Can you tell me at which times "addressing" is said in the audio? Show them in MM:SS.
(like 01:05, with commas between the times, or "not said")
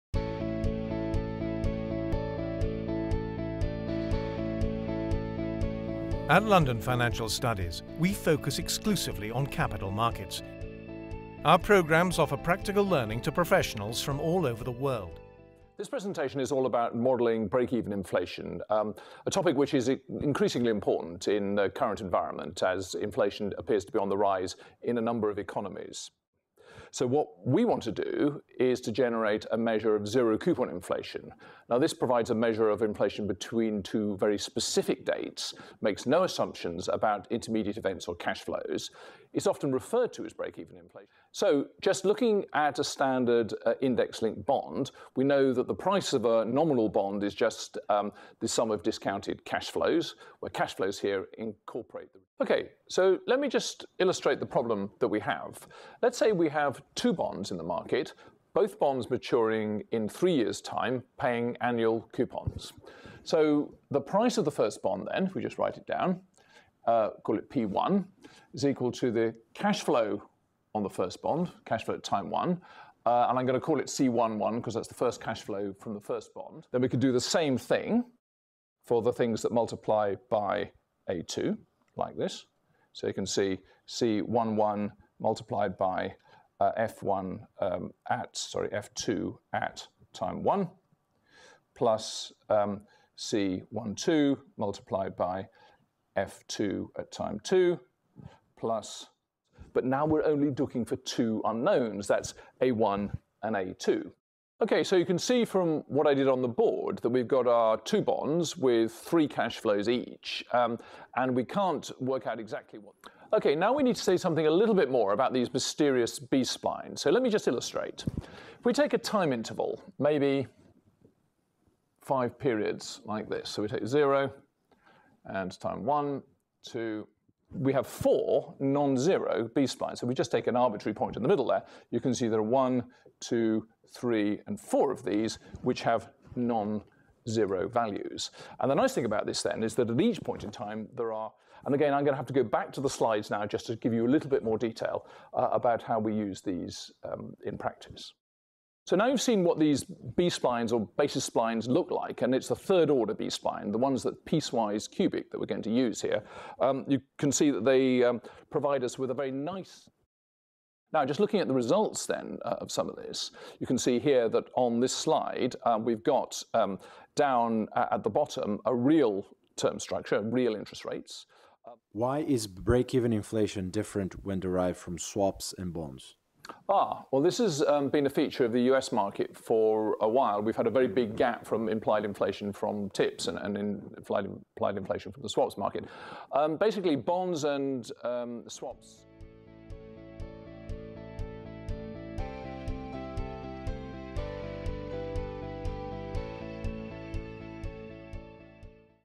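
not said.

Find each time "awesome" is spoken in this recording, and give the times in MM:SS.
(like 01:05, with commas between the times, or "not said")
not said.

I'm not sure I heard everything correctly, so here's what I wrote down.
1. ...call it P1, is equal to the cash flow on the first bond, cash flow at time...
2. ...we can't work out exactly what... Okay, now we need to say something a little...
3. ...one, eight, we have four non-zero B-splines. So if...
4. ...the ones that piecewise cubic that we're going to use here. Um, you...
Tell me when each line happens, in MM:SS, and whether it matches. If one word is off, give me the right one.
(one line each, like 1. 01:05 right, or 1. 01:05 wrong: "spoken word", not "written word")
1. 01:07 right
2. 01:51 right
3. 02:05 wrong: "two", not "eight"
4. 02:33 right.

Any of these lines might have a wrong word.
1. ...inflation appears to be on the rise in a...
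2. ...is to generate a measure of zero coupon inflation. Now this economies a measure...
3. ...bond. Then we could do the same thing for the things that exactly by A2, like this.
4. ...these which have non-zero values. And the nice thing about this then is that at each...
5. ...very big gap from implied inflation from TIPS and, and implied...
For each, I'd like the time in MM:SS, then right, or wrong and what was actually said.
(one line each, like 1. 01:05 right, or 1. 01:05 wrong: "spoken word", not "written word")
1. 00:22 right
2. 00:28 wrong: "provides", not "economies"
3. 01:16 wrong: "multiply", not "exactly"
4. 02:15 right
5. 03:00 right.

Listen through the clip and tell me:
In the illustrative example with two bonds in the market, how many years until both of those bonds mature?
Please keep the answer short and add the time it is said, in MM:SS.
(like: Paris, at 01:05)
3 years, at 01:00.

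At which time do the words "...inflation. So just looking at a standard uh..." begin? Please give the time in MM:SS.
00:40.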